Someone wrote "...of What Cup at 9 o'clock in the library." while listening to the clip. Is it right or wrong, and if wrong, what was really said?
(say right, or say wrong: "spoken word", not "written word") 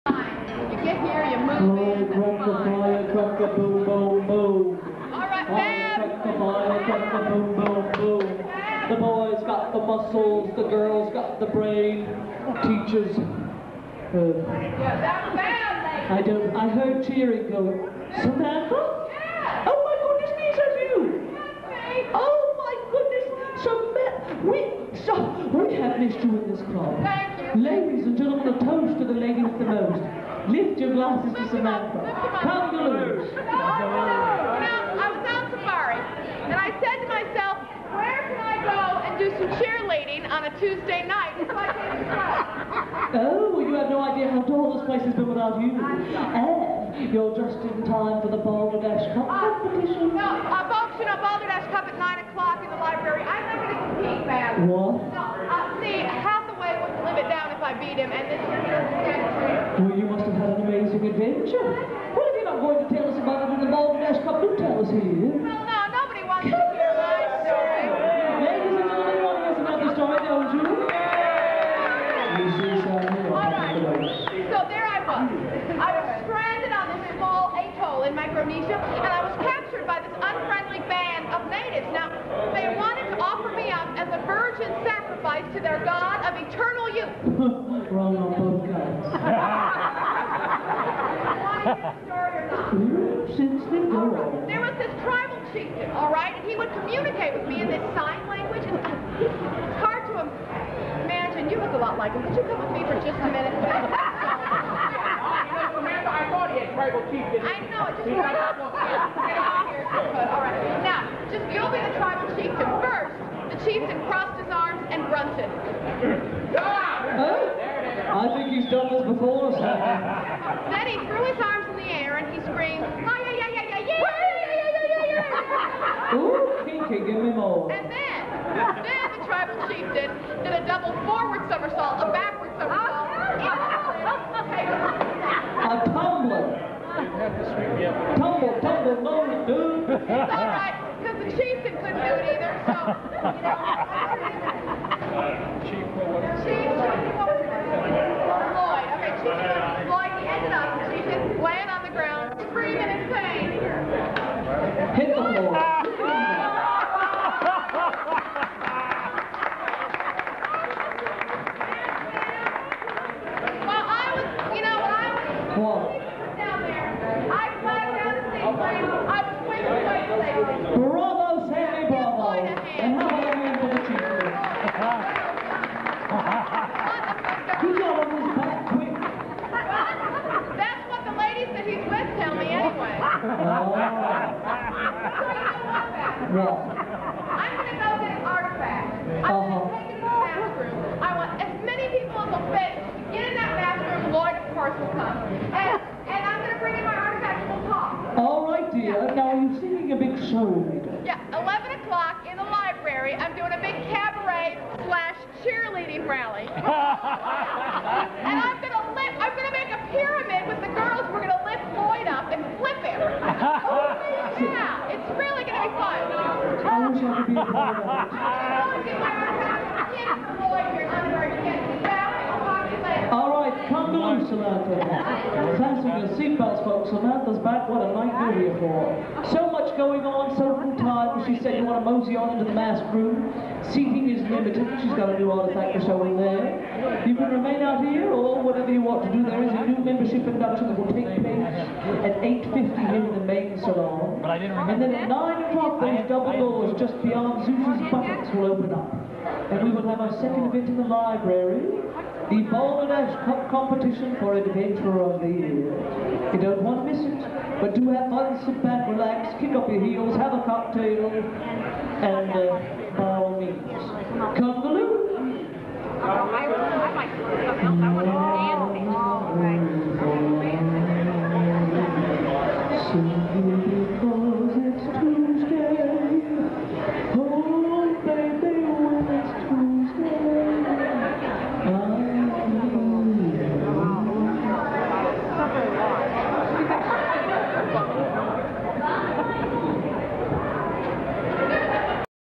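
wrong: "Balderdash", not "What".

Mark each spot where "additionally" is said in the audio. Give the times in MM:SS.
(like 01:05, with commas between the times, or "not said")
not said.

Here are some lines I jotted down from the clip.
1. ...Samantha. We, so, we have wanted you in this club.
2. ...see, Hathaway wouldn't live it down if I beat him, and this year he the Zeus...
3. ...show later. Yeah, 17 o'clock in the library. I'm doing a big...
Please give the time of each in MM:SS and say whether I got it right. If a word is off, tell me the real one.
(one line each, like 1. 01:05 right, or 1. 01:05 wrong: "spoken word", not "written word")
1. 00:24 wrong: "missed", not "wanted"
2. 00:55 wrong: "What", not "Zeus"
3. 03:20 wrong: "11", not "17".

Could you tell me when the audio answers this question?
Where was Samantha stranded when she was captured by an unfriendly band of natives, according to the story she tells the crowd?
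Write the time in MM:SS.
01:18.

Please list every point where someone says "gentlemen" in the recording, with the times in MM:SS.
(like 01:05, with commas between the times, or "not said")
00:28, 01:08.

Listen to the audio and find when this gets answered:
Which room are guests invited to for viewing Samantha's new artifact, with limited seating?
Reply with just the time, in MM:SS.
03:52.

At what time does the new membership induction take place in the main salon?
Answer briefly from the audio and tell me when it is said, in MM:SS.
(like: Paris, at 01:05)
8:50, at 04:02.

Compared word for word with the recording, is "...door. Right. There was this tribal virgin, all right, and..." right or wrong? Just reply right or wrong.
wrong.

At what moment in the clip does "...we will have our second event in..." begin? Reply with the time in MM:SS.
04:09.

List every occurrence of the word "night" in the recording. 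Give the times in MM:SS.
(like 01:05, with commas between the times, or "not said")
00:41, 03:47.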